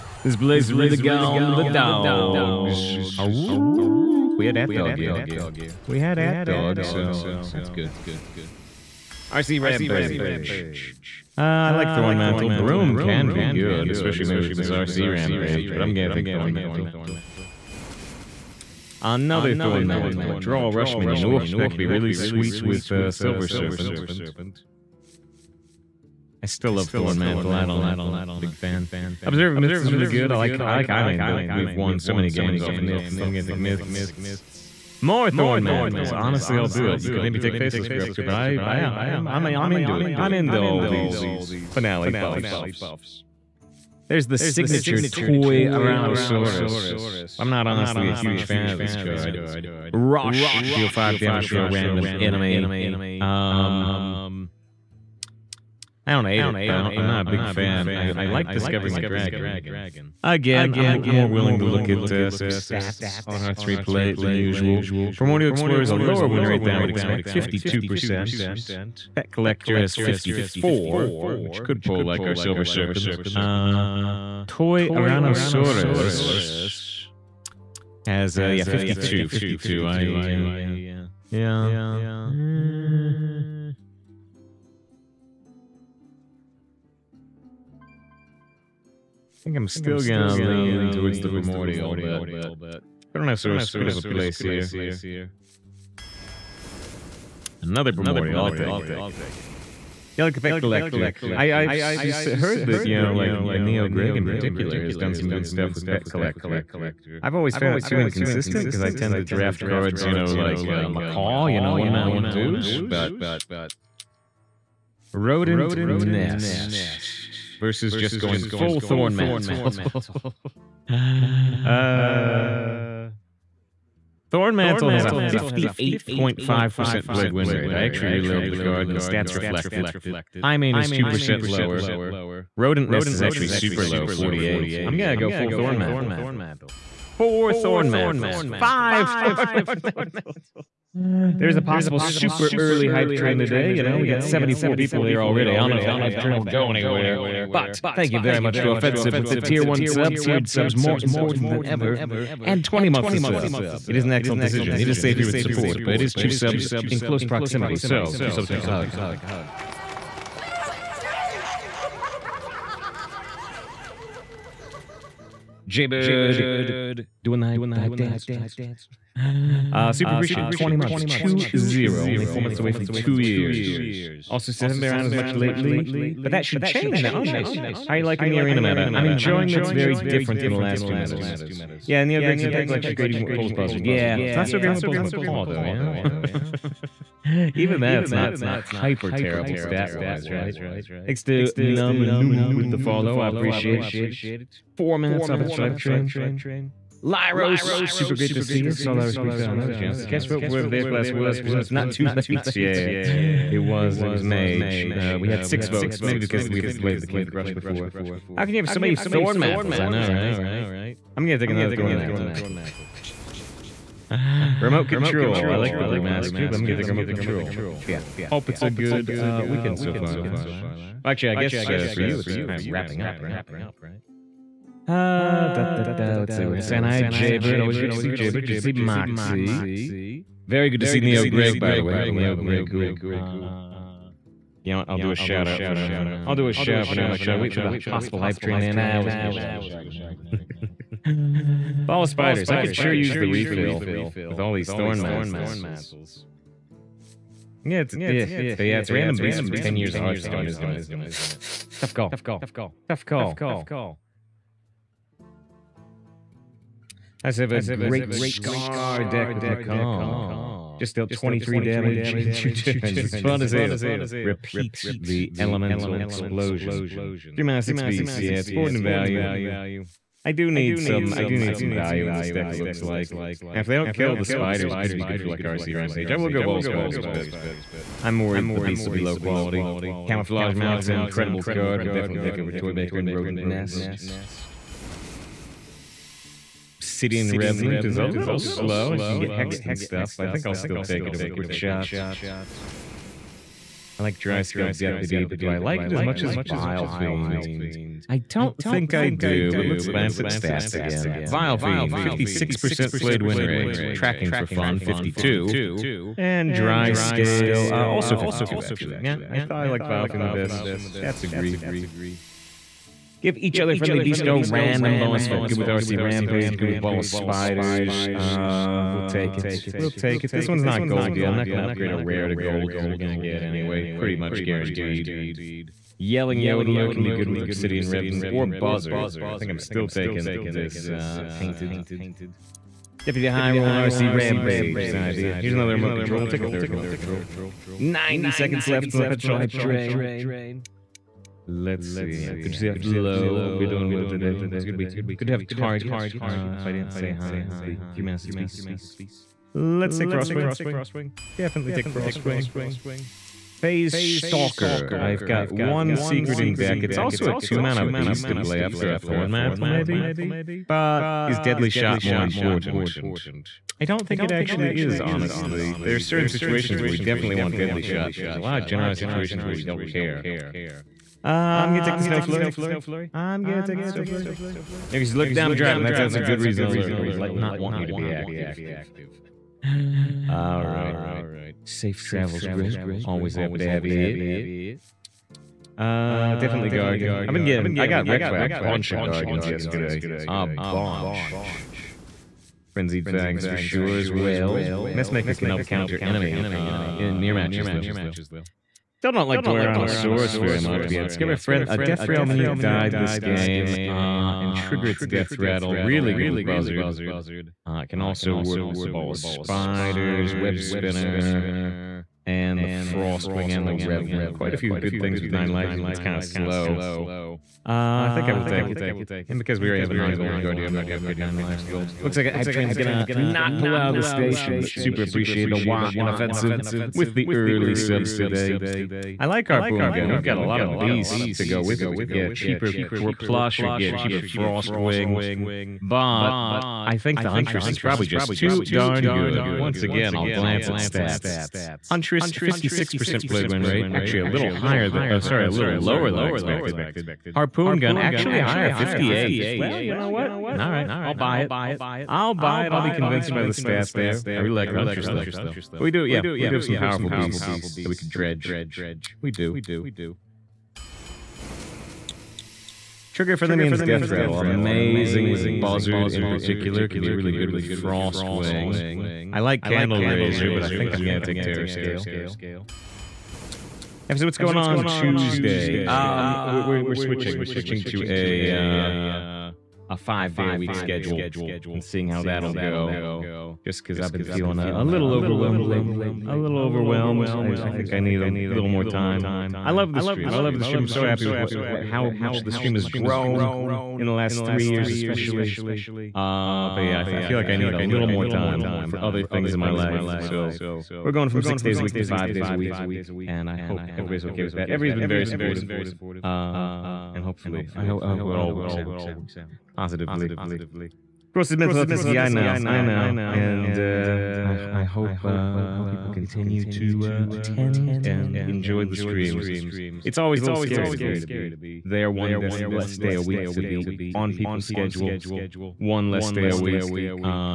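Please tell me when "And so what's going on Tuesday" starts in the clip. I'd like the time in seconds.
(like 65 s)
474 s.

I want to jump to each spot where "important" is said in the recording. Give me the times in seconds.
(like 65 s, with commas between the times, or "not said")
151 s, 362 s.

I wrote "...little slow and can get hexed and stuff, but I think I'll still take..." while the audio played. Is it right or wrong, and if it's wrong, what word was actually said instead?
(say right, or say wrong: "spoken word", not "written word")
right.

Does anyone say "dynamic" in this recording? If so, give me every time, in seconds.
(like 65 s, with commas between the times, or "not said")
not said.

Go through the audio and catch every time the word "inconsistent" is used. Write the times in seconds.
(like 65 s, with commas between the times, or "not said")
107 s.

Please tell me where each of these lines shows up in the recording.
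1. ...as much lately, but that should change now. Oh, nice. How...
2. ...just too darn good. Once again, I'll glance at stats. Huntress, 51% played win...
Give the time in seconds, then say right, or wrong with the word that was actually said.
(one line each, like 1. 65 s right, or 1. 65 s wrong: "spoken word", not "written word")
1. 175 s right
2. 438 s wrong: "56", not "51".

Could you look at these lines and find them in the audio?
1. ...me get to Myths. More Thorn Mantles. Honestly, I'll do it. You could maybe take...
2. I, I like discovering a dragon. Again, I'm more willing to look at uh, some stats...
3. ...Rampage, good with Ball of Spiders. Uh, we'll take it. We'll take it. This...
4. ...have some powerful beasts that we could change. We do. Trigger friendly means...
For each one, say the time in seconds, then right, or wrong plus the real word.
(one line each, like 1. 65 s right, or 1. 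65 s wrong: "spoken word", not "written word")
1. 33 s right
2. 57 s right
3. 315 s right
4. 456 s wrong: "dredge", not "change".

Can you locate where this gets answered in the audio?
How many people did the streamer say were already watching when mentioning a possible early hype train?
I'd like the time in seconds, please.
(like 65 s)
144 s.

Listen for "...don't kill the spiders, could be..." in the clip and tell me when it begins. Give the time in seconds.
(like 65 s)
273 s.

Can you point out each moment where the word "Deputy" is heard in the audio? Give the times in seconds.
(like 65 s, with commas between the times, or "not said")
294 s, 333 s.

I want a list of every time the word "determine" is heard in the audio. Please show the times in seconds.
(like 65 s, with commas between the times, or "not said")
not said.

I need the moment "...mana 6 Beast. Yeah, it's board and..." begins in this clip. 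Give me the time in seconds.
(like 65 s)
267 s.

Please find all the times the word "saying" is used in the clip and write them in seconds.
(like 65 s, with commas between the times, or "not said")
226 s.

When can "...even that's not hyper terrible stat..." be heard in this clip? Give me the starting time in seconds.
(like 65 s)
187 s.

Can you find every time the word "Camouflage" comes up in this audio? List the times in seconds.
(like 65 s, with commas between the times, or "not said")
280 s.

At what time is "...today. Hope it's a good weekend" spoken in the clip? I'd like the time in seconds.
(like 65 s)
344 s.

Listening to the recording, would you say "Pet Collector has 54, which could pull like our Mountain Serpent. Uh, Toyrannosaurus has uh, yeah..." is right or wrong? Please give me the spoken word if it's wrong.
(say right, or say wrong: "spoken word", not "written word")
wrong: "Silver", not "Mountain".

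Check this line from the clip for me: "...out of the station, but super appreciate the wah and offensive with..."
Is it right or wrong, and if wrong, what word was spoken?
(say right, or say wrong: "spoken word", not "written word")
right.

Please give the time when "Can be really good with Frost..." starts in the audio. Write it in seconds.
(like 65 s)
466 s.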